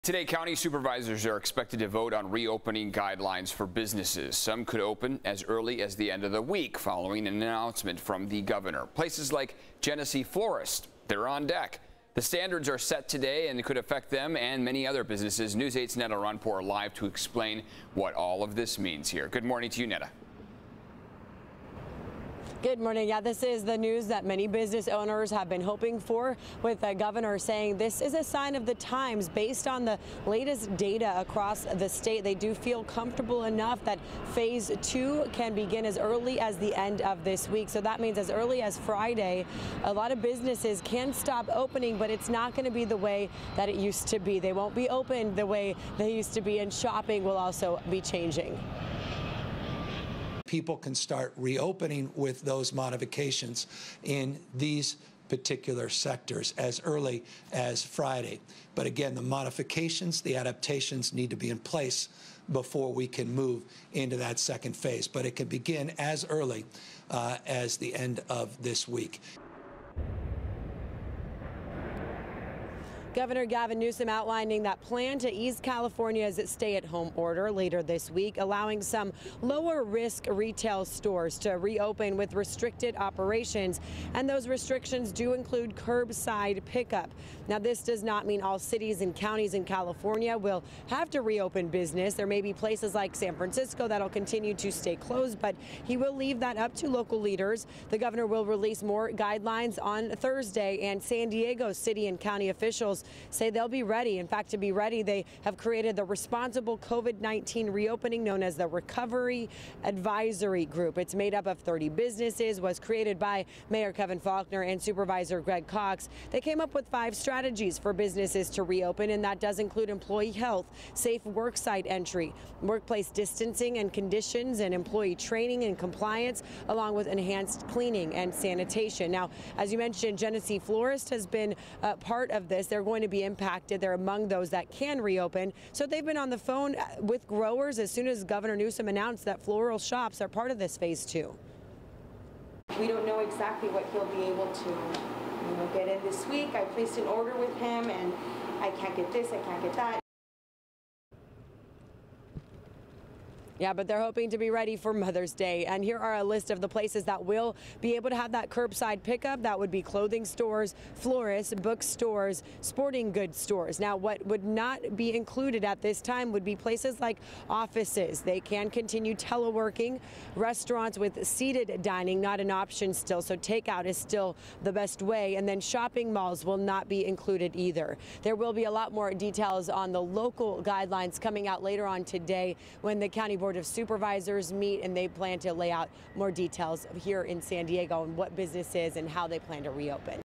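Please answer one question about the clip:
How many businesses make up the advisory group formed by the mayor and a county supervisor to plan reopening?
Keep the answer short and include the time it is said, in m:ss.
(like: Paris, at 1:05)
30, at 1:51.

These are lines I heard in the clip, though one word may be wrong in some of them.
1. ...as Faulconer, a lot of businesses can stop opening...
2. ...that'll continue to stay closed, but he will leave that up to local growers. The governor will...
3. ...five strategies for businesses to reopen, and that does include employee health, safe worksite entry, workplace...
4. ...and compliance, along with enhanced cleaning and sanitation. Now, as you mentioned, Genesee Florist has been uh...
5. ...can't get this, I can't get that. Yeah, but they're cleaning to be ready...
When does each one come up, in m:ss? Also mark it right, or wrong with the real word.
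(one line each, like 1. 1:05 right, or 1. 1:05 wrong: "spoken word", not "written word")
1. 0:38 wrong: "Friday", not "Faulconer"
2. 1:33 wrong: "leaders", not "growers"
3. 1:56 right
4. 2:05 right
5. 2:28 wrong: "hoping", not "cleaning".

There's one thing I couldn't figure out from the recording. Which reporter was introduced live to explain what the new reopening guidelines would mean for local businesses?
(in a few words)
Neda Iranpour.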